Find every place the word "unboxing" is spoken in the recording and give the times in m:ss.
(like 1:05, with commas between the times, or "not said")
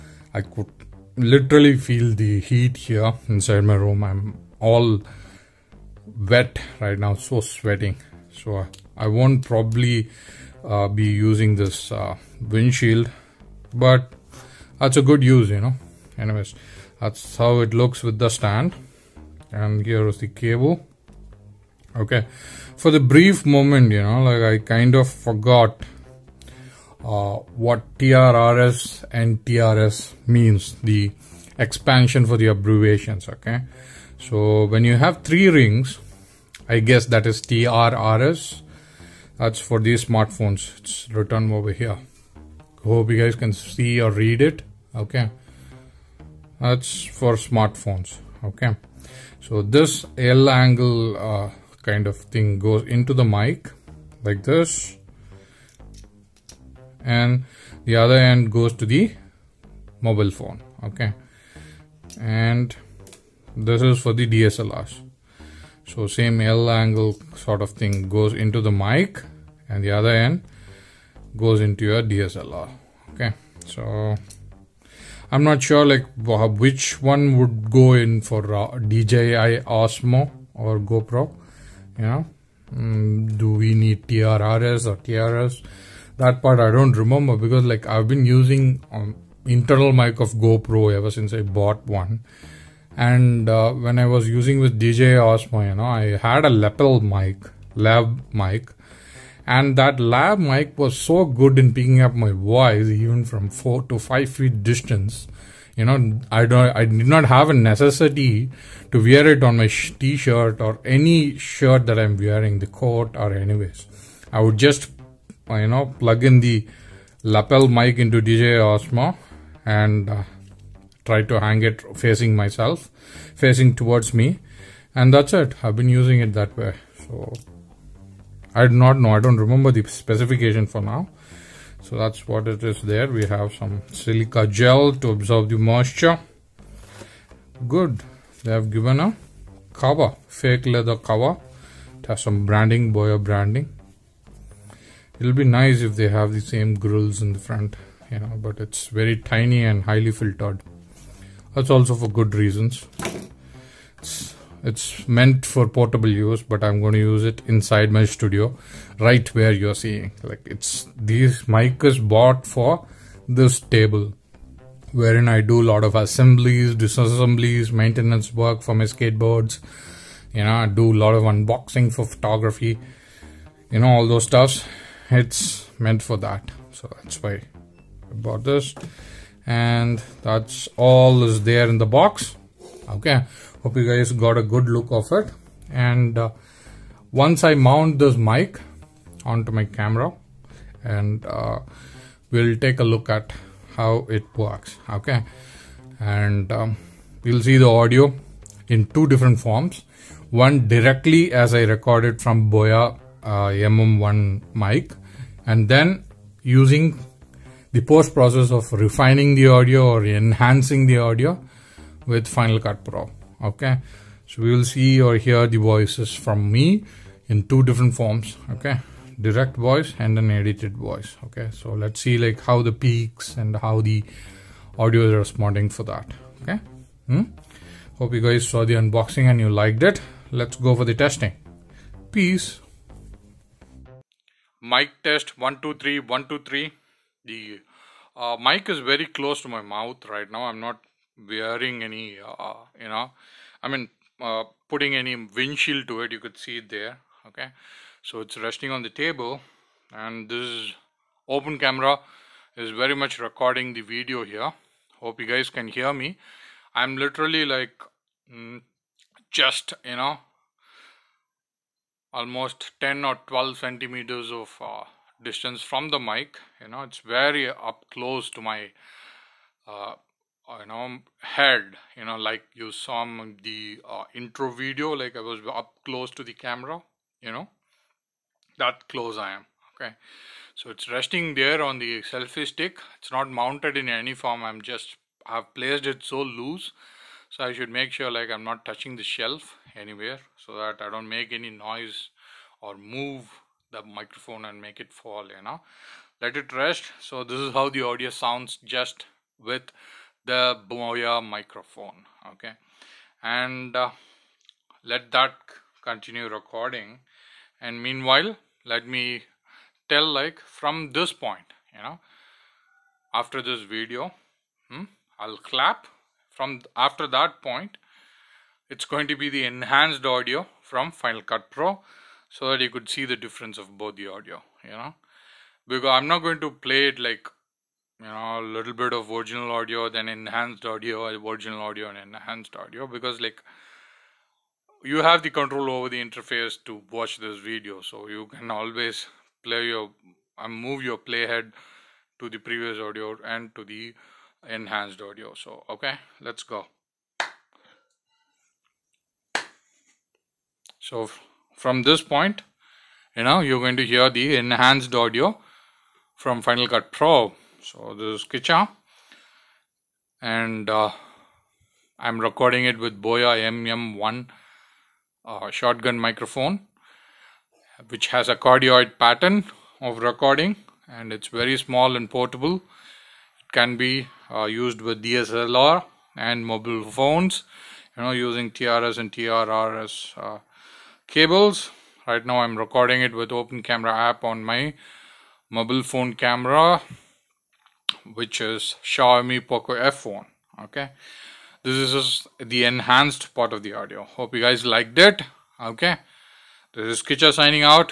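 2:51, 3:48.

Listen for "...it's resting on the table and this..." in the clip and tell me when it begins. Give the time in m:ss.
4:08.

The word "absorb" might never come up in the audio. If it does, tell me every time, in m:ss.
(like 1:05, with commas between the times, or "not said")
2:15.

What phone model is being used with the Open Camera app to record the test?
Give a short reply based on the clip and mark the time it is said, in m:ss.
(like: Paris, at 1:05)
Xiaomi Poco F1, at 6:28.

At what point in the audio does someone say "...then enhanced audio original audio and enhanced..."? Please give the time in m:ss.
5:29.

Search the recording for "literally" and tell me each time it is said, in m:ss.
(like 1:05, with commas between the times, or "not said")
0:01, 4:16.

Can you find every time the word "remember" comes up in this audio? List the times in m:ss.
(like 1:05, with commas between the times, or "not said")
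1:26, 2:09.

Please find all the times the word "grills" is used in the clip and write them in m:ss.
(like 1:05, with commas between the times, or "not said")
2:26.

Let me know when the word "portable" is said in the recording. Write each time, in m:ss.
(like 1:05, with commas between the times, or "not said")
2:35, 6:12.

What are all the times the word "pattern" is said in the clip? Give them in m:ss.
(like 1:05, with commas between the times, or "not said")
6:08.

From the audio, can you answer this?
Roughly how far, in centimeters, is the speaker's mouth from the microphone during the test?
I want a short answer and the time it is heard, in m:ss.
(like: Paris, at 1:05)
10 or 12 centimeters, at 4:22.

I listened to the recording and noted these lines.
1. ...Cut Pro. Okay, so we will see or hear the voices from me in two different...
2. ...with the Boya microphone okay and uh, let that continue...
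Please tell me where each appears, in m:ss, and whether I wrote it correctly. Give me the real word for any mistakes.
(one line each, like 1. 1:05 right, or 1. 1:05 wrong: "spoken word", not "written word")
1. 3:32 right
2. 4:59 right.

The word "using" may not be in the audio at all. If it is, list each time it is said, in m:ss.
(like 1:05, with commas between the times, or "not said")
0:11, 1:28, 1:34, 2:05, 3:26, 6:18.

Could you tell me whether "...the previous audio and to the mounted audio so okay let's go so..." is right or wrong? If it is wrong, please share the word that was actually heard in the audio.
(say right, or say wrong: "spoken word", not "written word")
wrong: "enhanced", not "mounted".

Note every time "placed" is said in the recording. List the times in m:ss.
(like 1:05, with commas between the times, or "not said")
4:45.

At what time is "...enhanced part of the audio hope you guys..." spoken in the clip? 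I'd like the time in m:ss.
6:32.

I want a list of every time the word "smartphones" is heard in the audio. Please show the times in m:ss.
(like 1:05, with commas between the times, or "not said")
0:40, 0:47.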